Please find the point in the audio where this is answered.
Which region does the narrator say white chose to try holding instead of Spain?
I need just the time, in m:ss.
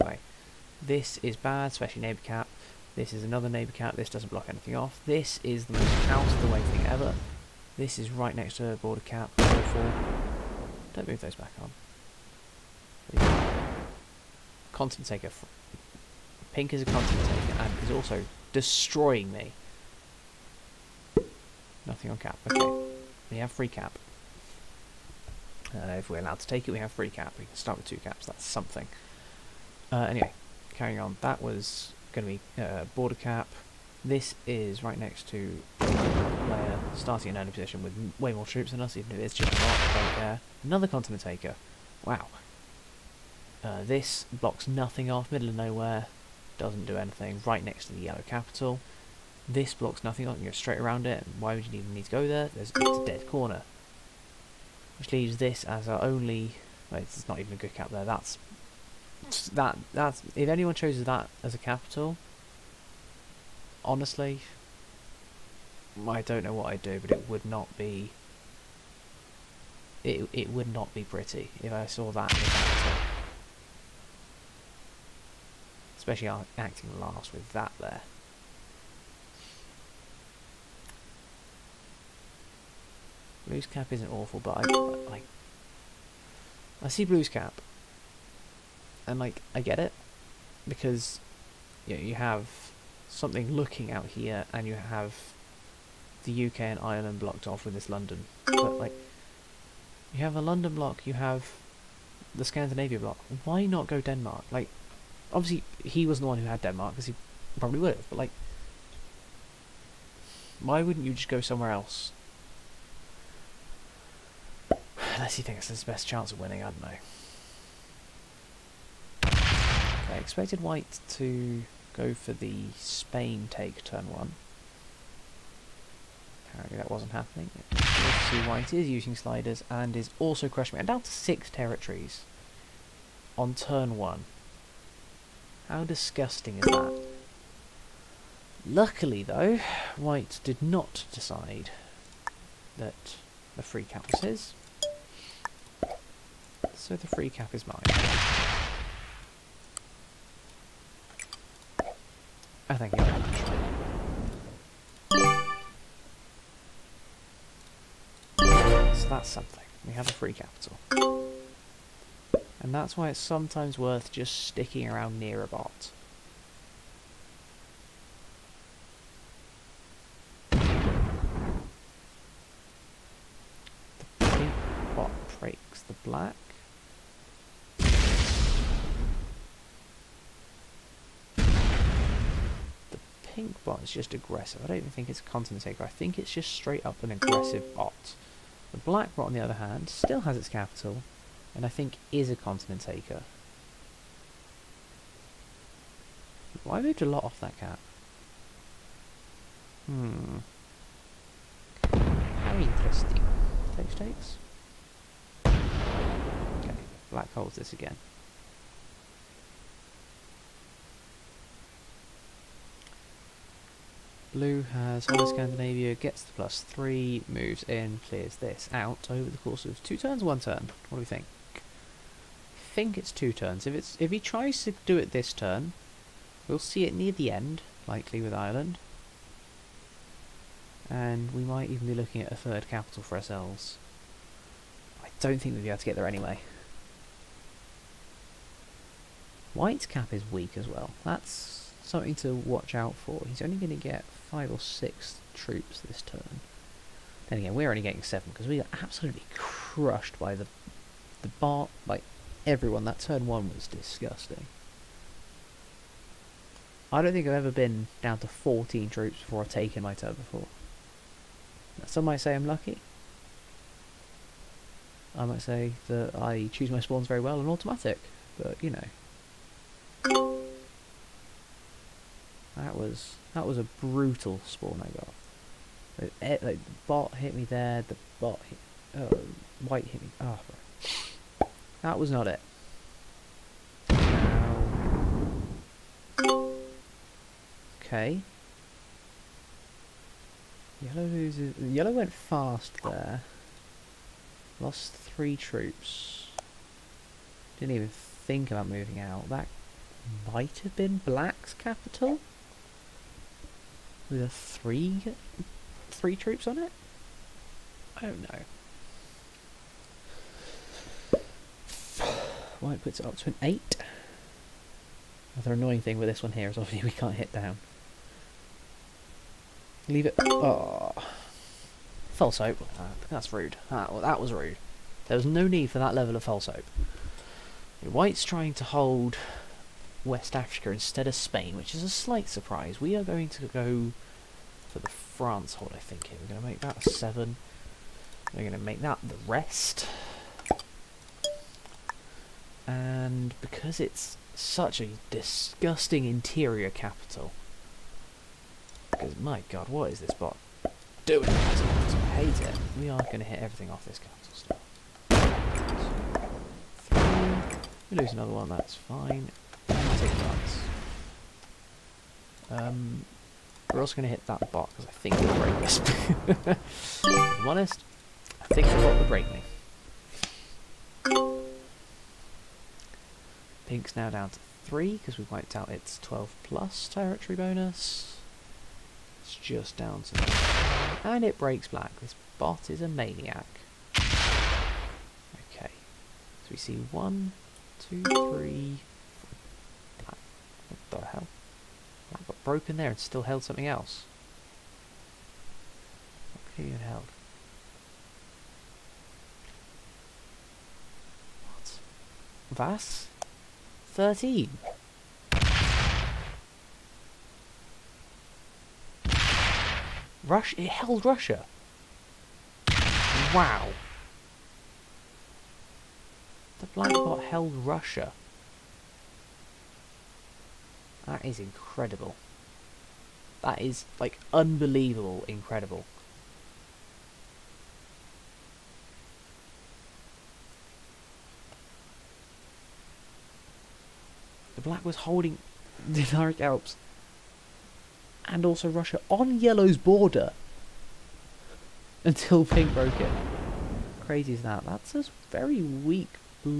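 5:30.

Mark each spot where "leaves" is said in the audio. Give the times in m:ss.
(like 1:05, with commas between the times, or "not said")
0:55, 5:19.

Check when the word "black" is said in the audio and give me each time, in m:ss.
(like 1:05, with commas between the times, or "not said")
2:56, 3:08, 3:27, 5:01, 6:21, 7:14.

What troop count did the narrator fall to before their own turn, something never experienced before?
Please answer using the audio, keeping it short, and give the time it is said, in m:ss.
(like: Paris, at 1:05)
14, at 4:18.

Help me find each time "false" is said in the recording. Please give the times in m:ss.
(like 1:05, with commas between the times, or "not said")
5:22, 5:26.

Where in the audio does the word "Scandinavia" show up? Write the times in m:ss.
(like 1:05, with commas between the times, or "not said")
1:42, 3:35.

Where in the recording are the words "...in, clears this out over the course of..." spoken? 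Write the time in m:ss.
3:37.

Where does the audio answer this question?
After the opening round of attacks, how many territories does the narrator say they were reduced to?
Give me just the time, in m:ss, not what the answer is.
2:11.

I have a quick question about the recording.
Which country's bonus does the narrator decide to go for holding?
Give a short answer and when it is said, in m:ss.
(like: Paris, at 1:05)
France, at 5:34.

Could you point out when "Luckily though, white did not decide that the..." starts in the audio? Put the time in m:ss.
2:18.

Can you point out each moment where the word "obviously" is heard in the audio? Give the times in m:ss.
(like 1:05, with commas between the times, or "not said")
1:45, 5:16.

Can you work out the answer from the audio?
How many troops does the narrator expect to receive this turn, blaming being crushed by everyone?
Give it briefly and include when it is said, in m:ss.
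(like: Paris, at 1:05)
7, at 4:08.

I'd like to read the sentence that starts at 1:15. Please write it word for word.
Especially acting last with that there.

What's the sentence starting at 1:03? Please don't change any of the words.
Honestly, I don't know what I'd do, but it would not be.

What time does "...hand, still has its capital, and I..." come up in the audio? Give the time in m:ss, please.
3:09.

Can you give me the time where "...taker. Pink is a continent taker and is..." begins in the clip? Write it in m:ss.
0:15.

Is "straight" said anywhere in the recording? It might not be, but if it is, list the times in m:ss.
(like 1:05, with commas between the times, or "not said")
0:50, 3:06.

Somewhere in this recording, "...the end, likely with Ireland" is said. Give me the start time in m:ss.
3:47.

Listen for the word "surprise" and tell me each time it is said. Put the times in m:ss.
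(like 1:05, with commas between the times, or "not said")
5:32.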